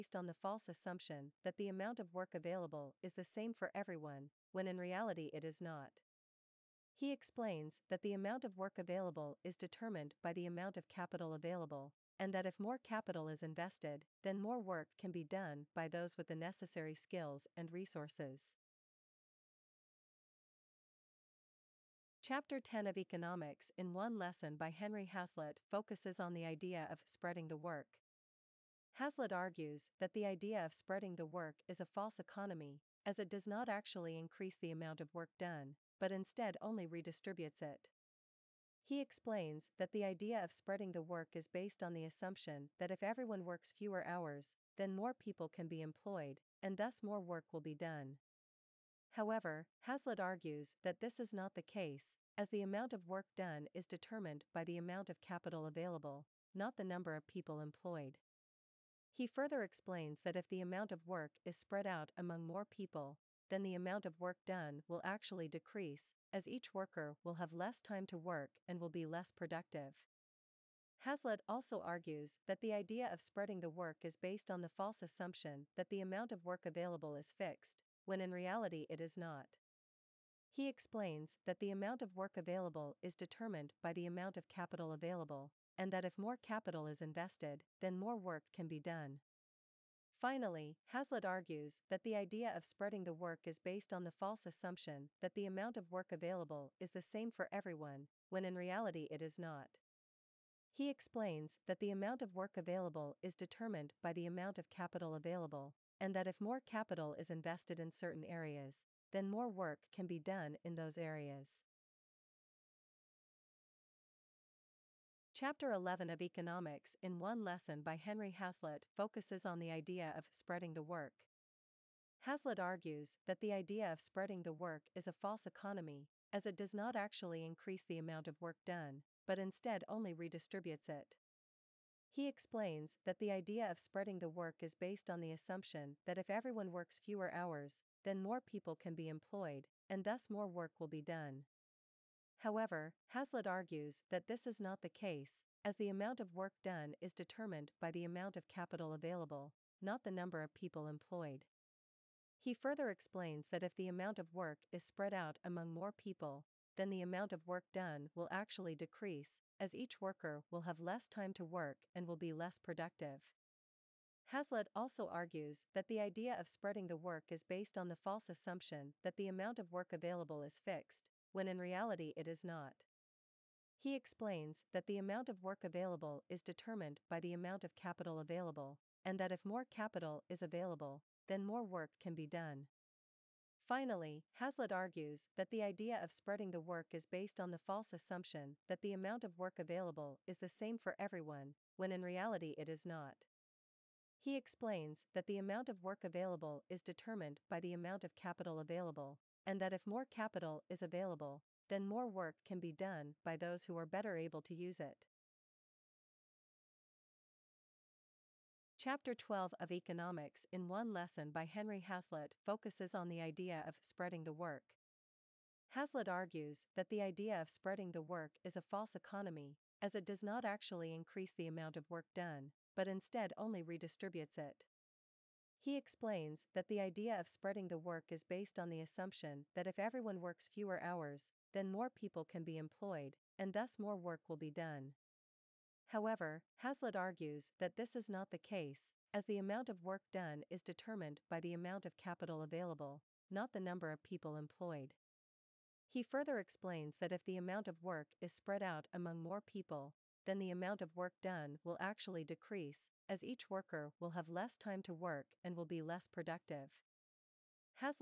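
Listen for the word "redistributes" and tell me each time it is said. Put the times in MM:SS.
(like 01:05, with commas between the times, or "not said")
00:36, 02:10, 03:43.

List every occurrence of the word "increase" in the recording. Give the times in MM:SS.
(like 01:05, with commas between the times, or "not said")
00:34, 02:07, 03:40.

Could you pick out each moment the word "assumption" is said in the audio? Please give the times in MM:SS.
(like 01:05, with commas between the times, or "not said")
00:00, 00:42, 01:15, 01:34, 02:15, 02:48, 03:07, 03:48.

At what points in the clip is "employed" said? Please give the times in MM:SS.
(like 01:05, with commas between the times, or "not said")
00:45, 00:57, 02:19, 02:30, 03:52, 04:04.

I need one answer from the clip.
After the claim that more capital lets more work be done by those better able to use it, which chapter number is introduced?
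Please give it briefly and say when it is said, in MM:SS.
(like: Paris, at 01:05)
12, at 03:28.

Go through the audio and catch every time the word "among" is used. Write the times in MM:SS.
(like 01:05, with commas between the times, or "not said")
01:02, 02:35, 04:08.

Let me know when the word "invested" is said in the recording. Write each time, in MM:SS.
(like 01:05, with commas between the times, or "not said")
00:13, 01:27, 01:47.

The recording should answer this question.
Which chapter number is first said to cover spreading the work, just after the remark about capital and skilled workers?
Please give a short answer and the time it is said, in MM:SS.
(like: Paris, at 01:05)
10, at 00:22.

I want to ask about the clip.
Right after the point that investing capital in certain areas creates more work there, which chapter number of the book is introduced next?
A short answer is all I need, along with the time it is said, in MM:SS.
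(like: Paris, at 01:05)
11, at 01:55.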